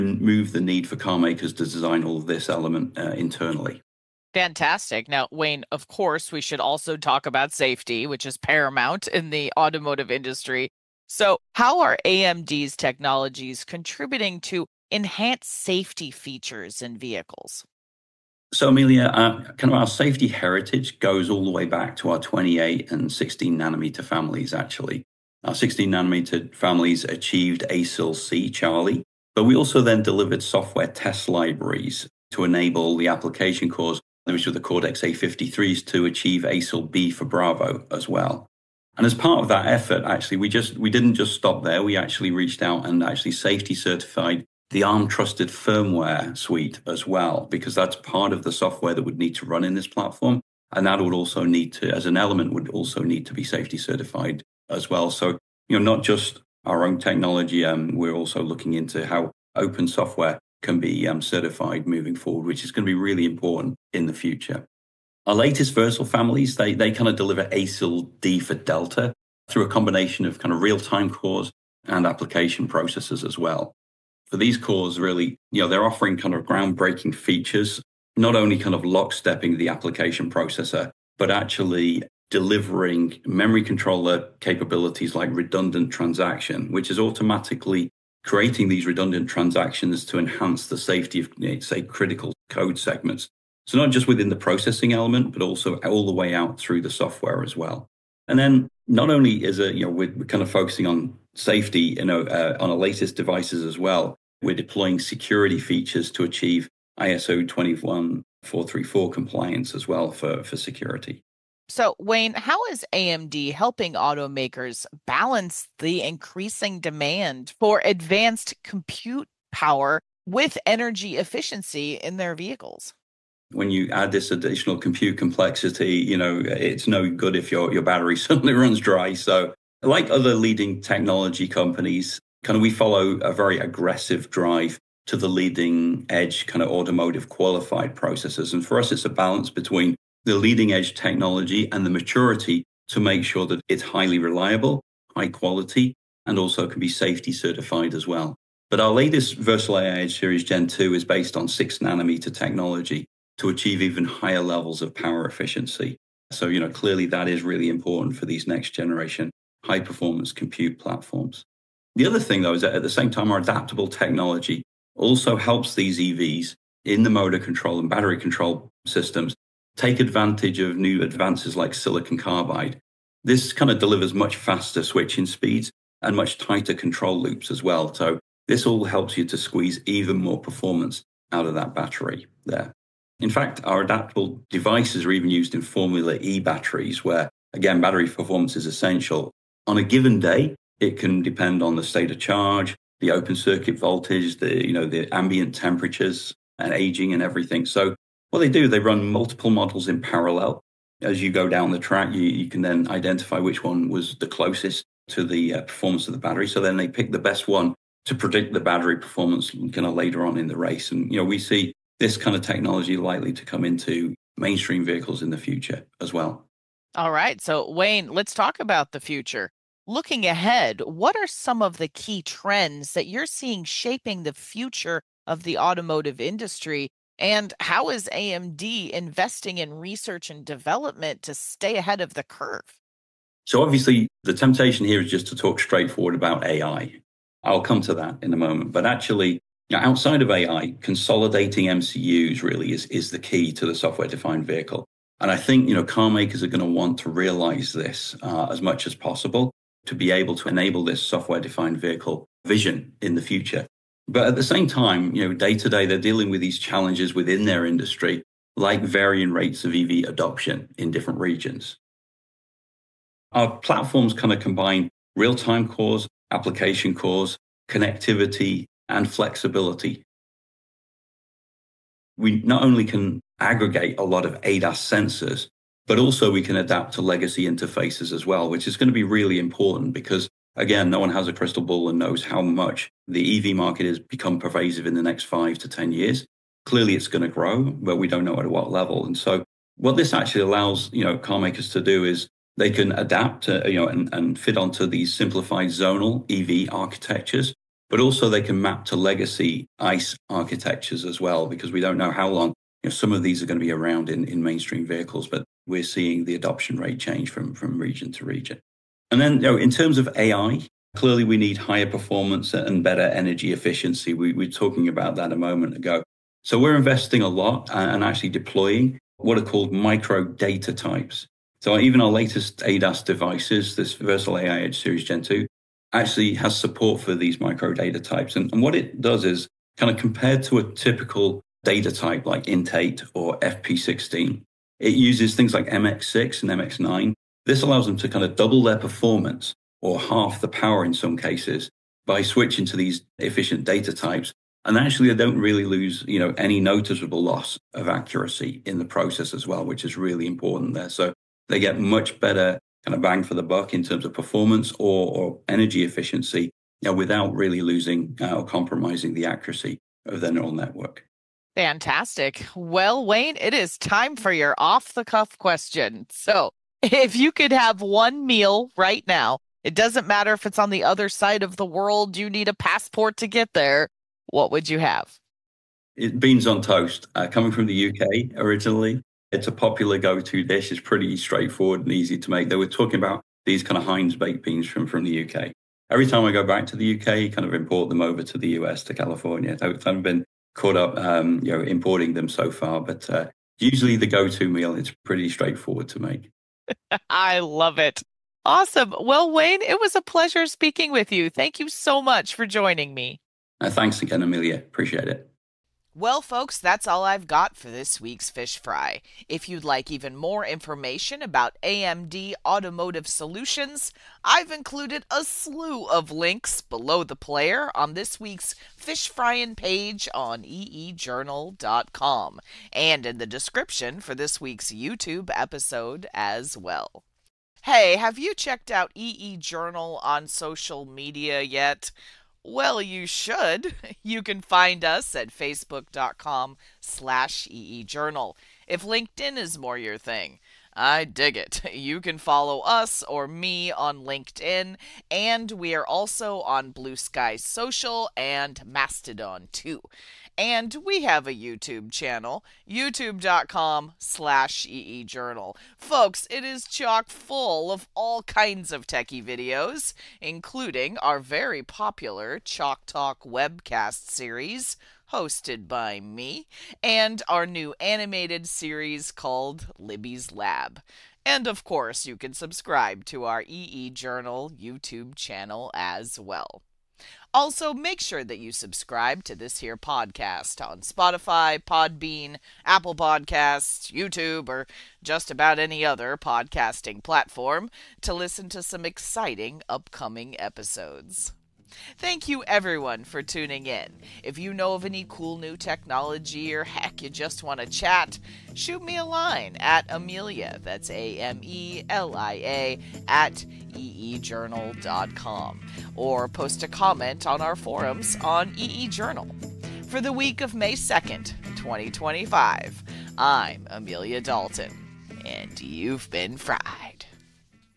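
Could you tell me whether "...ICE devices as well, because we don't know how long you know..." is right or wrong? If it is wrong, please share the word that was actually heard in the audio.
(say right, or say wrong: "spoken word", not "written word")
wrong: "architectures", not "devices".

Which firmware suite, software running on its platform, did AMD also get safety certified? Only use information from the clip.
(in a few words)
ARM trusted firmware.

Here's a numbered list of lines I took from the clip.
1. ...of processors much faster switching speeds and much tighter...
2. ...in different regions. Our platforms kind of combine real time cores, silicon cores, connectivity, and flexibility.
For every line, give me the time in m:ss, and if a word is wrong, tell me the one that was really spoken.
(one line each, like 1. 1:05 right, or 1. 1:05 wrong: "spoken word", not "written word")
1. 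2:53 wrong: "delivers", not "processors"
2. 4:20 wrong: "application", not "silicon".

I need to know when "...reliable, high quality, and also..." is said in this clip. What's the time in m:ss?
2:24.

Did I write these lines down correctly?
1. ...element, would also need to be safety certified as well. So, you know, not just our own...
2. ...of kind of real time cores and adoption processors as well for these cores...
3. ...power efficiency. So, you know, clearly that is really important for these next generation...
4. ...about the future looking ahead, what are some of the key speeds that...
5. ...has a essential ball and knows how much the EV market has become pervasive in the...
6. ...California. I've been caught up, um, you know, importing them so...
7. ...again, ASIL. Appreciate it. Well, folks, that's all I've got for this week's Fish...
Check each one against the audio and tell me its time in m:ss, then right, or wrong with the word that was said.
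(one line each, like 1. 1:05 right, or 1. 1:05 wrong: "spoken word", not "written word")
1. 0:52 right
2. 1:10 wrong: "application", not "adoption"
3. 2:34 right
4. 3:38 wrong: "trends", not "speeds"
5. 4:41 wrong: "crystal", not "essential"
6. 6:28 right
7. 6:44 wrong: "Amelia", not "ASIL".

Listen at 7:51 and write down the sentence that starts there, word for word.
And of course, you can subscribe to our EE Journal YouTube channel as well.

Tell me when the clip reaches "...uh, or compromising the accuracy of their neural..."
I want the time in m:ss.
5:58.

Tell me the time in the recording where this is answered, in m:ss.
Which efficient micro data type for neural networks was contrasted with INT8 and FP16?
5:35.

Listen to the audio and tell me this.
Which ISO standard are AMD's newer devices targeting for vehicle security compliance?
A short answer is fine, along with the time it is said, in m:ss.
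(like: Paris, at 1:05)
ISO 21434, at 1:46.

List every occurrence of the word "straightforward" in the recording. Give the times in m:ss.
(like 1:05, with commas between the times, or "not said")
3:55, 6:21, 6:35.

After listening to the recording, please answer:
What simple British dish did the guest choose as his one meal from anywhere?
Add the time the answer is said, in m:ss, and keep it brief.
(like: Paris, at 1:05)
beans on toast, at 6:16.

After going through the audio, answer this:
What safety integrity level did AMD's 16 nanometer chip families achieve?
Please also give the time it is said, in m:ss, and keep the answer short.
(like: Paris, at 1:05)
ASIL C, at 0:27.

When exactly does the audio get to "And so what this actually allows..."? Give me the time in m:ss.
4:49.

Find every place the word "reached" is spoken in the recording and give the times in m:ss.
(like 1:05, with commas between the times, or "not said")
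0:42.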